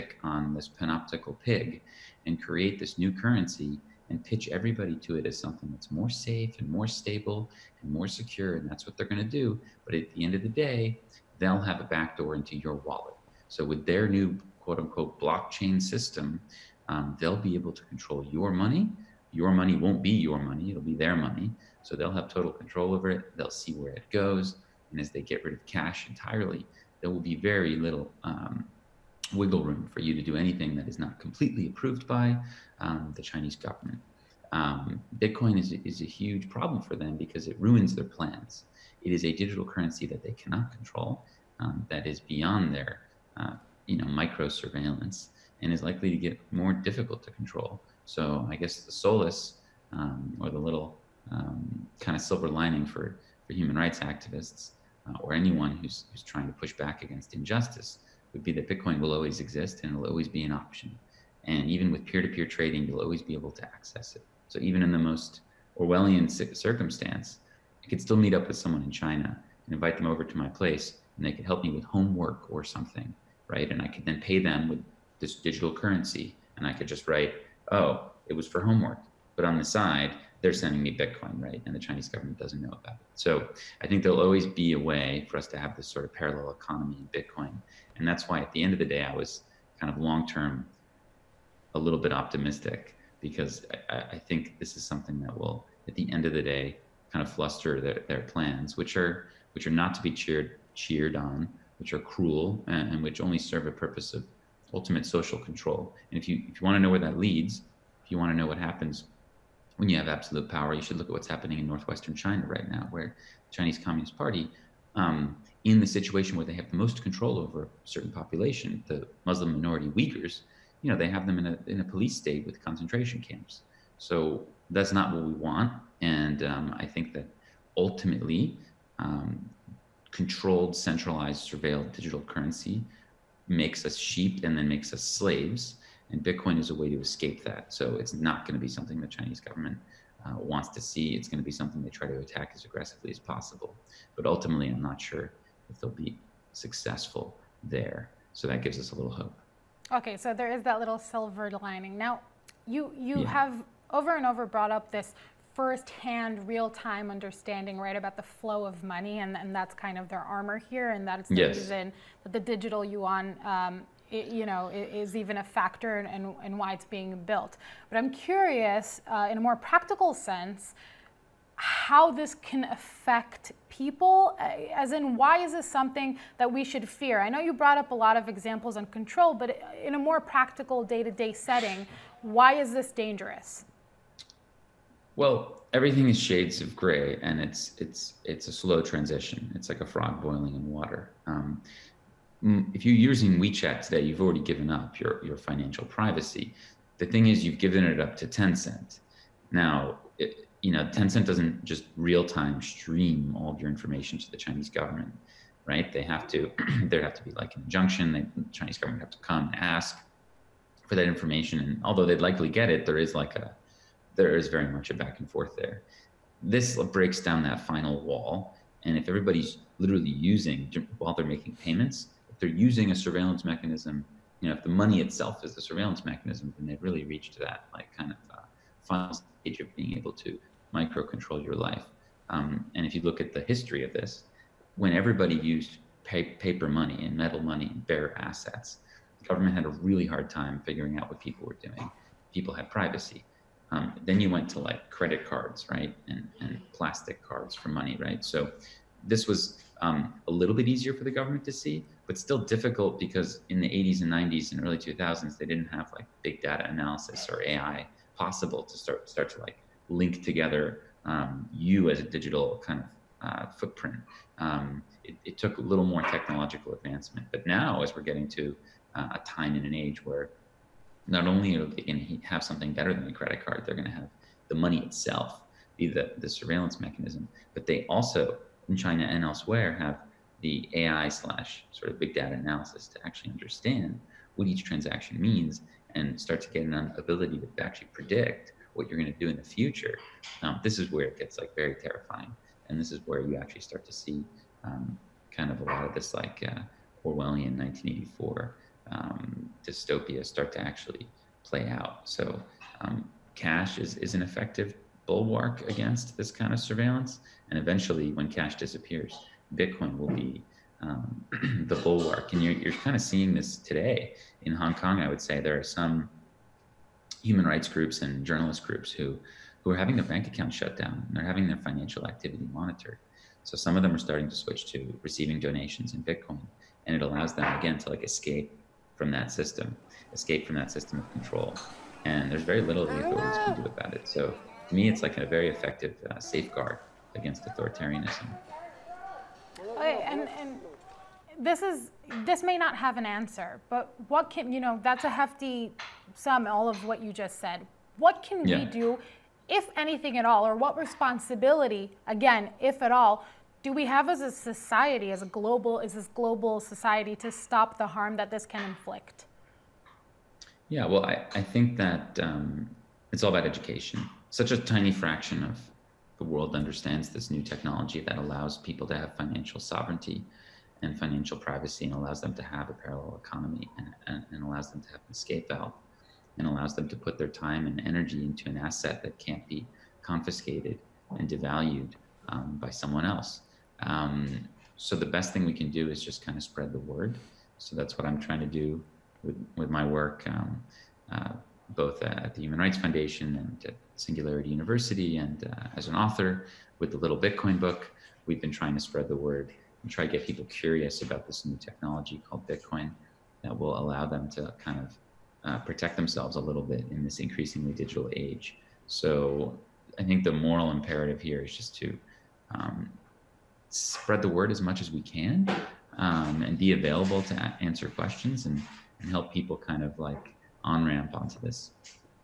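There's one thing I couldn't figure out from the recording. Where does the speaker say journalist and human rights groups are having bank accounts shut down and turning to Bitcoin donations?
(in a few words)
Hong Kong.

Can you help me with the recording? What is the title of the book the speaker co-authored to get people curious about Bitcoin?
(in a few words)
The Little Bitcoin Book.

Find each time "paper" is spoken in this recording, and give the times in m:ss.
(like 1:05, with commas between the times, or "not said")
3:56.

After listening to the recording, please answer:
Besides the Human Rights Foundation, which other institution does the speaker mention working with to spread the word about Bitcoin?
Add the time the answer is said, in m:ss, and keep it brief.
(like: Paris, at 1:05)
Singularity University, at 6:33.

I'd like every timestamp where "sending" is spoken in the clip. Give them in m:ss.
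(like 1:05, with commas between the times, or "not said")
1:20.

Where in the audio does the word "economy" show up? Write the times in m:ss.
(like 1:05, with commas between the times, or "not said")
1:26, 6:13.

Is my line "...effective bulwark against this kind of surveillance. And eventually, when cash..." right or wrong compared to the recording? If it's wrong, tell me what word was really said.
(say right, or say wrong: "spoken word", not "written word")
right.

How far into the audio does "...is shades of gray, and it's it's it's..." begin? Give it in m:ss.
3:06.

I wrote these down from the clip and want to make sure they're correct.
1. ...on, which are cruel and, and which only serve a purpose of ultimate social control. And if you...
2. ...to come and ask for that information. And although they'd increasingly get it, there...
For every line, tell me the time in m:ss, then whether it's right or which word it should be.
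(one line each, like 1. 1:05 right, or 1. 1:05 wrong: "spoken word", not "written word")
1. 1:41 right
2. 3:29 wrong: "likely", not "increasingly".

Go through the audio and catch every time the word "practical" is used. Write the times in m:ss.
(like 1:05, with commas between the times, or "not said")
2:49, 3:00.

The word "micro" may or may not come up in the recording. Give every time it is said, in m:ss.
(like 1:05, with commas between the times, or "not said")
0:44, 3:50.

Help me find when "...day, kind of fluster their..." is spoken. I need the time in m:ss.
1:36.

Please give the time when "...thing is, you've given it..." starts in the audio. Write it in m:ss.
3:17.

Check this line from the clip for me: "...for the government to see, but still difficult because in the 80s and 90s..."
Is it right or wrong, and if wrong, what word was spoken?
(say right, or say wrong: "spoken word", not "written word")
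right.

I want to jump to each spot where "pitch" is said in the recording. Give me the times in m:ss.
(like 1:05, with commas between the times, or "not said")
0:04.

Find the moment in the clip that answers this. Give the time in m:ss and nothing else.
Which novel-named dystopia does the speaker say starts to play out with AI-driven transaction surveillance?
4:57.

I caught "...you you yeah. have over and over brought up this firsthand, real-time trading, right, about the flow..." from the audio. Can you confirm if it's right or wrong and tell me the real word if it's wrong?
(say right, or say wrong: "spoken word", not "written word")
wrong: "understanding", not "trading".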